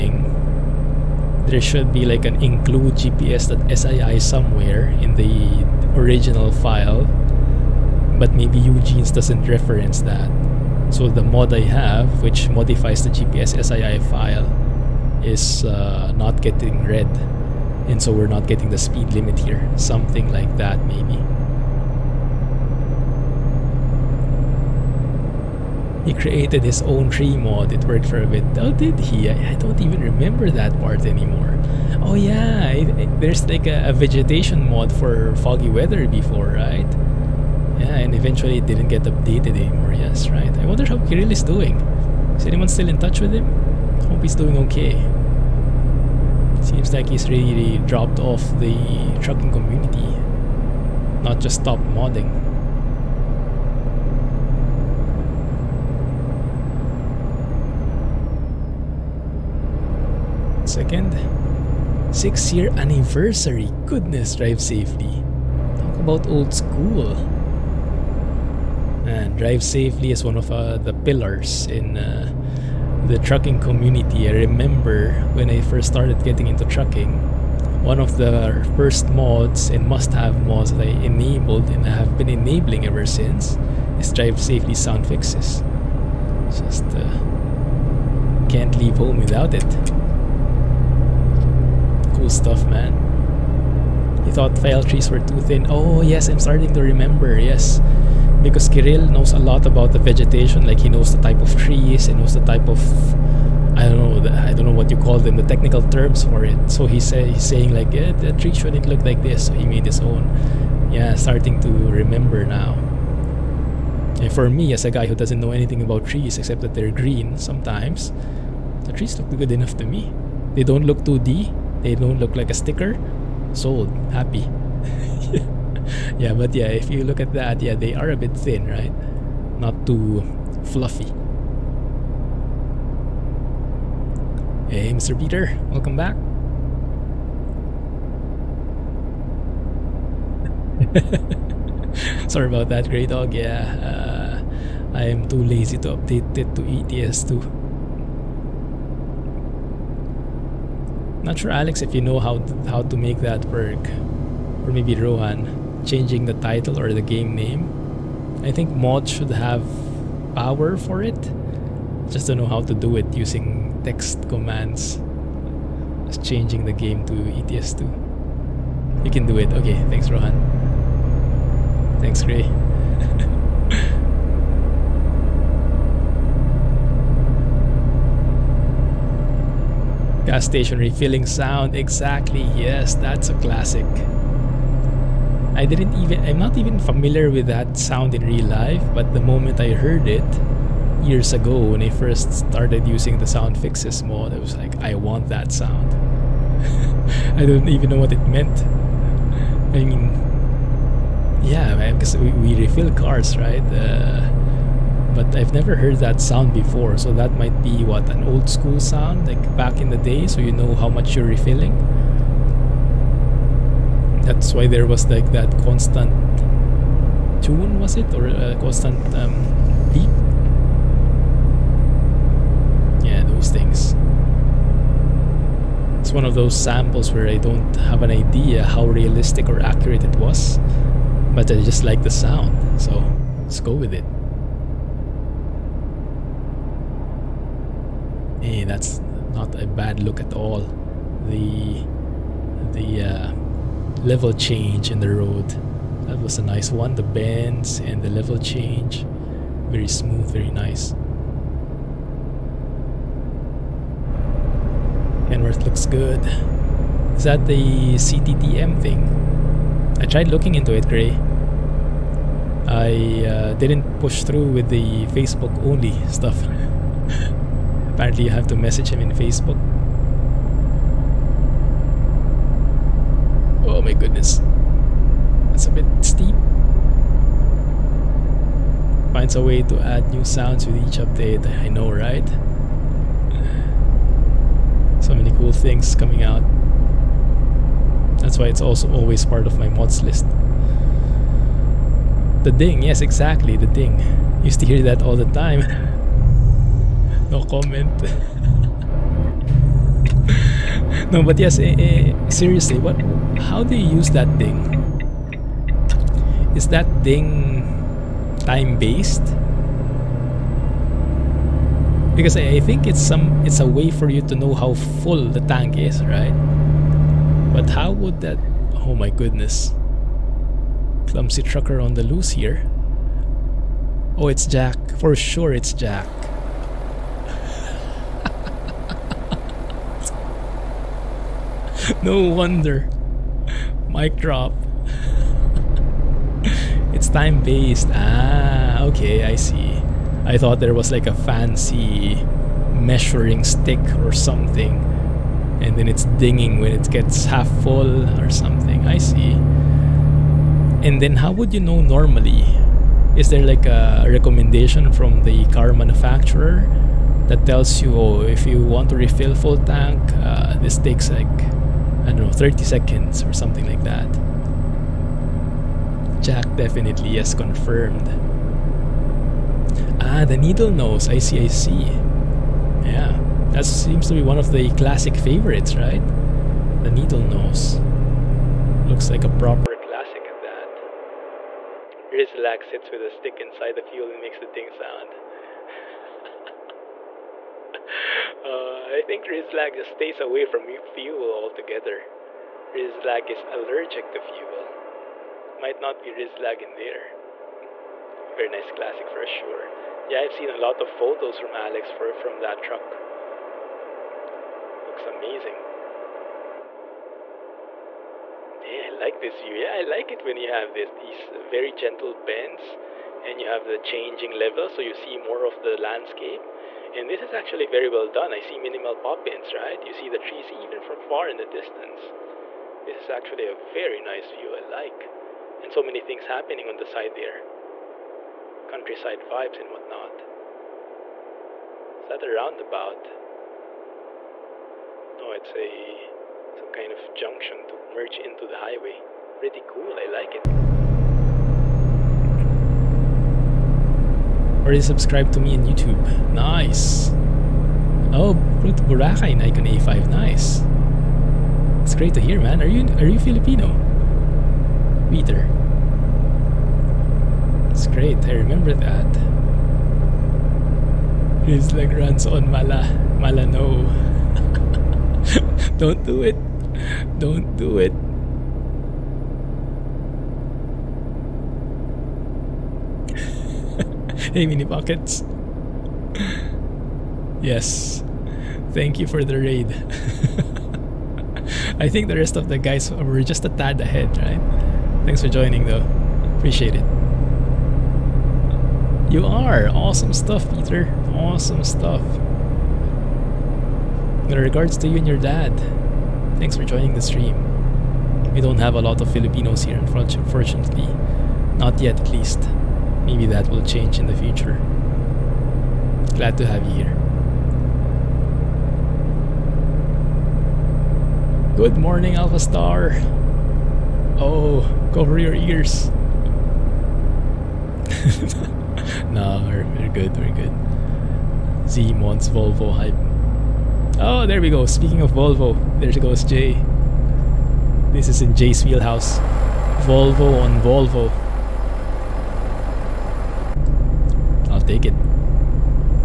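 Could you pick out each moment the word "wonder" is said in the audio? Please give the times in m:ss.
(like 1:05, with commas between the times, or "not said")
0:40, 5:32.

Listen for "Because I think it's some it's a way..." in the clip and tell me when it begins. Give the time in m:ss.
5:12.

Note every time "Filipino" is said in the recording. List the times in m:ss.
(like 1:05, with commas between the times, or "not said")
7:33, 8:19.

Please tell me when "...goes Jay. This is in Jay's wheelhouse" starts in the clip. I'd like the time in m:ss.
8:45.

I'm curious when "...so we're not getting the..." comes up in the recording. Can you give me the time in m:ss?
0:18.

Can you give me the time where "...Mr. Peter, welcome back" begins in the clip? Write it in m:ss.
2:14.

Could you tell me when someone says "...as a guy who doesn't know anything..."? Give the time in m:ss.
1:54.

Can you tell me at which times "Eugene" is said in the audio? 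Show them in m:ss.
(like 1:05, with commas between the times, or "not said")
0:08.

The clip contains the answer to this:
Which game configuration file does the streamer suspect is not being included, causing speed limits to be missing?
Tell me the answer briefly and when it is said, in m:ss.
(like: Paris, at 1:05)
gps.sii, at 0:02.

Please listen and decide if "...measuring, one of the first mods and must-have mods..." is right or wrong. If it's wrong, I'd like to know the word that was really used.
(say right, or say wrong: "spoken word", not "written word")
wrong: "trucking", not "measuring".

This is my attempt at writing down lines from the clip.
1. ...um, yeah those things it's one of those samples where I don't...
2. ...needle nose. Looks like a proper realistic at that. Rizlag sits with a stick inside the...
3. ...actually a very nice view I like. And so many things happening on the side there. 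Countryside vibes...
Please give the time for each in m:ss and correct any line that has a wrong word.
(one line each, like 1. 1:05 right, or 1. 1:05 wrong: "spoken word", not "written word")
1. 3:39 right
2. 6:16 wrong: "classic", not "realistic"
3. 7:03 right.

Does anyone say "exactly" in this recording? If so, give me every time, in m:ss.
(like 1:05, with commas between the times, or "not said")
3:01, 4:53.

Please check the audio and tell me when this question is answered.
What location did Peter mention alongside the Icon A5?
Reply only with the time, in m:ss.
7:28.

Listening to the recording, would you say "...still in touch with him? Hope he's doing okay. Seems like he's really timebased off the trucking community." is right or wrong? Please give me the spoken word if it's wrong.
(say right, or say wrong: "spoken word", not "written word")
wrong: "dropped", not "timebased".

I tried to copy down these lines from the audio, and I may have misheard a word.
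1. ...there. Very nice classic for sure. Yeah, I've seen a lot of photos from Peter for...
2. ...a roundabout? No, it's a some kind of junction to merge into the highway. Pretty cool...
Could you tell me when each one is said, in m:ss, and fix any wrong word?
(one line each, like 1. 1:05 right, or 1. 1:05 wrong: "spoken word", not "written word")
1. 6:36 wrong: "Alex", not "Peter"
2. 7:12 right.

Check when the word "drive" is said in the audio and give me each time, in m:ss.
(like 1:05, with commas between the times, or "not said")
1:04, 1:09, 1:24.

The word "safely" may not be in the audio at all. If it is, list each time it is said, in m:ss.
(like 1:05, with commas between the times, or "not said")
1:04, 1:09, 1:24.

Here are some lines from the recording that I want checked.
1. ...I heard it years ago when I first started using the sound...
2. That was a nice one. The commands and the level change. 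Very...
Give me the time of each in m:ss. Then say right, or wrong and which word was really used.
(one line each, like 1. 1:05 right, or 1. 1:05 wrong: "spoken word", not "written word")
1. 3:09 right
2. 4:06 wrong: "bends", not "commands".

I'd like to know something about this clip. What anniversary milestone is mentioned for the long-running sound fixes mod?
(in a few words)
6 years.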